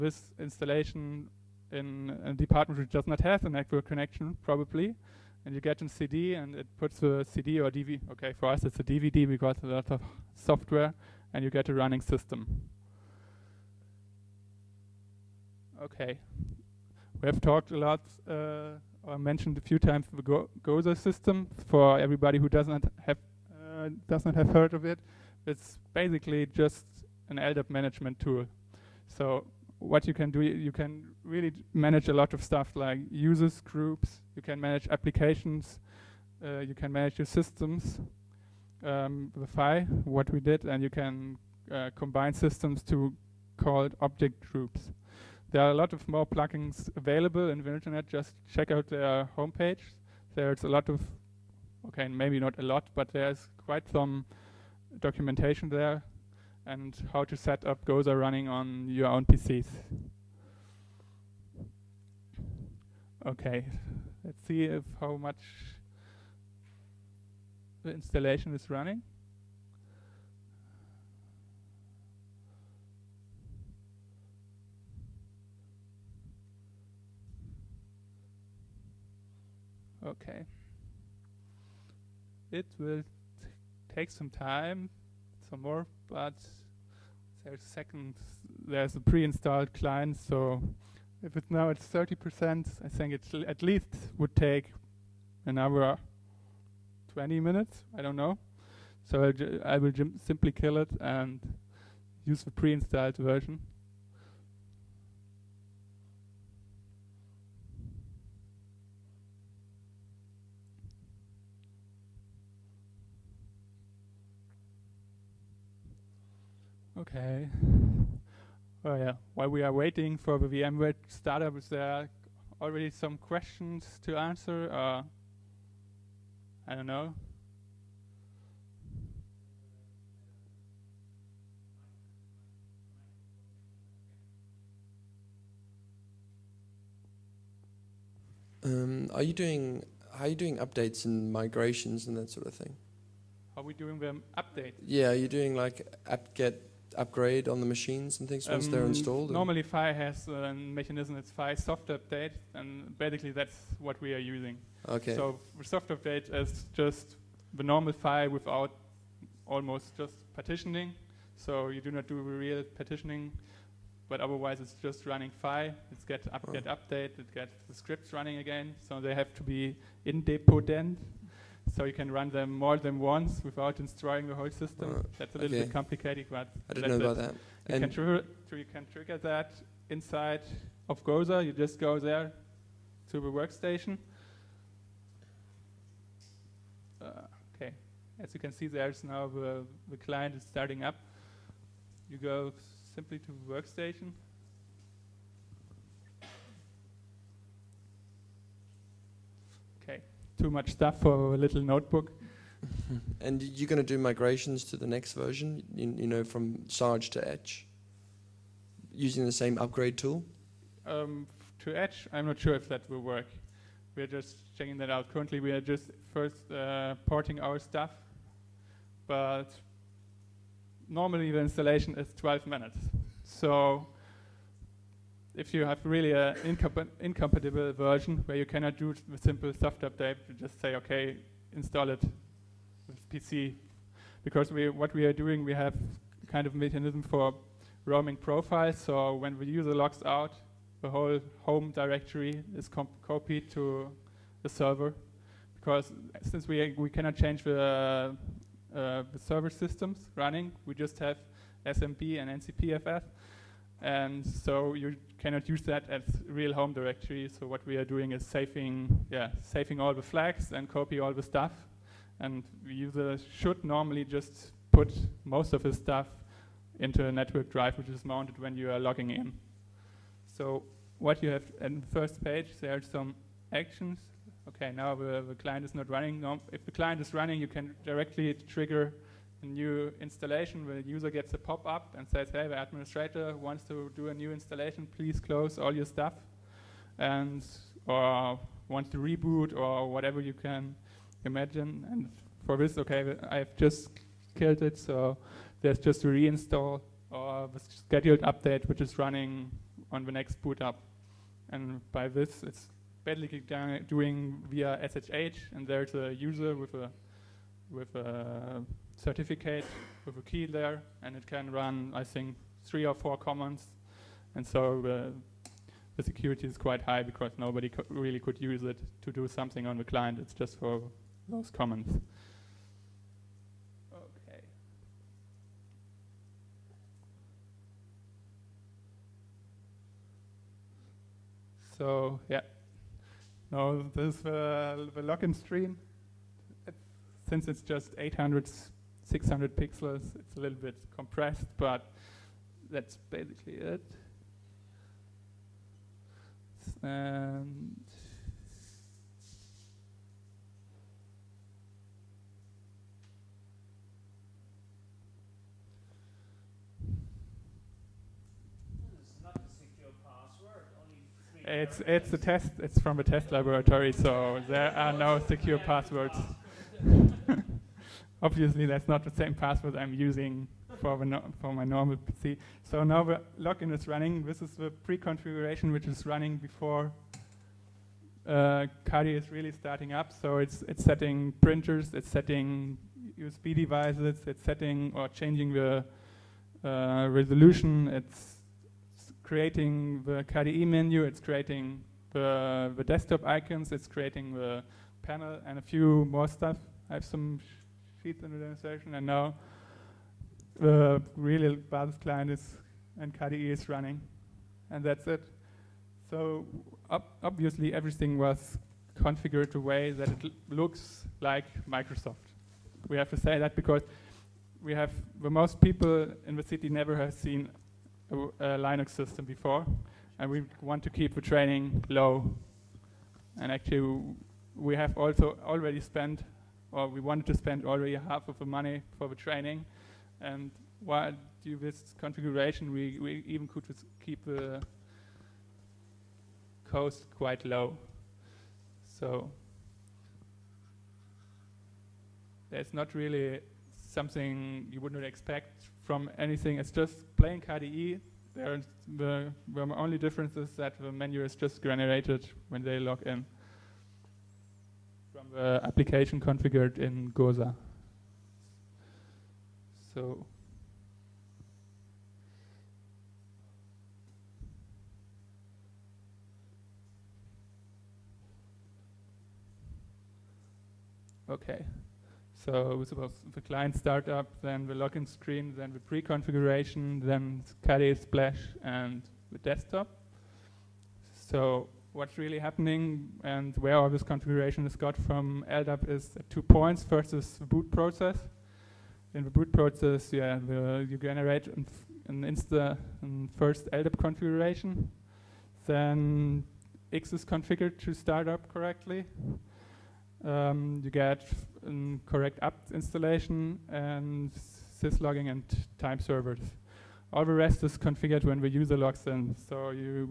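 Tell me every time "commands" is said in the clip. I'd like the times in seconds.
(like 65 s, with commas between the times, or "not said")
313 s, 321 s.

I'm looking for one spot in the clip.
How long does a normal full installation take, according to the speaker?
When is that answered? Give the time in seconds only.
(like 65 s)
222 s.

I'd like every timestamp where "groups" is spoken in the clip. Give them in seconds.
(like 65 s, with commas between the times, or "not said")
33 s, 44 s.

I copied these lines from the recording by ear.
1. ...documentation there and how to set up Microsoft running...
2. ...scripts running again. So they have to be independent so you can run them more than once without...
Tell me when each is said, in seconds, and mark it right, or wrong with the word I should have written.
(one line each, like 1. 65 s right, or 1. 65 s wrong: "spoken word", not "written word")
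1. 54 s wrong: "GOsa", not "Microsoft"
2. 167 s right.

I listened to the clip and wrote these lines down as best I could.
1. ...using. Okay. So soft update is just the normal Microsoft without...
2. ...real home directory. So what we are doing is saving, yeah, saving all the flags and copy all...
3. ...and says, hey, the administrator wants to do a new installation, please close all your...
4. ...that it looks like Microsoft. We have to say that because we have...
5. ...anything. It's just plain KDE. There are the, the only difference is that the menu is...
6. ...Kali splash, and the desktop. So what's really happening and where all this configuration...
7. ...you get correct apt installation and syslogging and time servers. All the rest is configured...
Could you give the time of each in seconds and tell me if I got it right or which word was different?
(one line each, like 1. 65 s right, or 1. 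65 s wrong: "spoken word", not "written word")
1. 154 s wrong: "FAI", not "Microsoft"
2. 256 s right
3. 281 s right
4. 409 s right
5. 446 s right
6. 477 s right
7. 500 s right.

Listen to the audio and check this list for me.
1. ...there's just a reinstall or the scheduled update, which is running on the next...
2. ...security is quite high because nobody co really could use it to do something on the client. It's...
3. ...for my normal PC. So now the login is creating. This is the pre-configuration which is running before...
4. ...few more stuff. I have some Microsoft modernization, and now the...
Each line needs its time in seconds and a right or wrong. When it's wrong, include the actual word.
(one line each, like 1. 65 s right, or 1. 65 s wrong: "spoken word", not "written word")
1. 295 s right
2. 316 s right
3. 371 s wrong: "running", not "creating"
4. 395 s wrong: "Sheets", not "Microsoft".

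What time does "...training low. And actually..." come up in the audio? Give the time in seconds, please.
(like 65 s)
421 s.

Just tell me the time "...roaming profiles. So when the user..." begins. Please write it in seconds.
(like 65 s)
237 s.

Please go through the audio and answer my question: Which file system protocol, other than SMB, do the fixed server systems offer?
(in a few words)
NCPFS.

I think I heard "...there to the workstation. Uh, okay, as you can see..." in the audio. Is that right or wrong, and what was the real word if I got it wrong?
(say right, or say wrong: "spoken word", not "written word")
right.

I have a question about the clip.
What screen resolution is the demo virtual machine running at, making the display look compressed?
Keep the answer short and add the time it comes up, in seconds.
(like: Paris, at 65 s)
800x600, at 337 s.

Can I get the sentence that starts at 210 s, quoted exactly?
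Um, to Etch, I'm not sure if that will work.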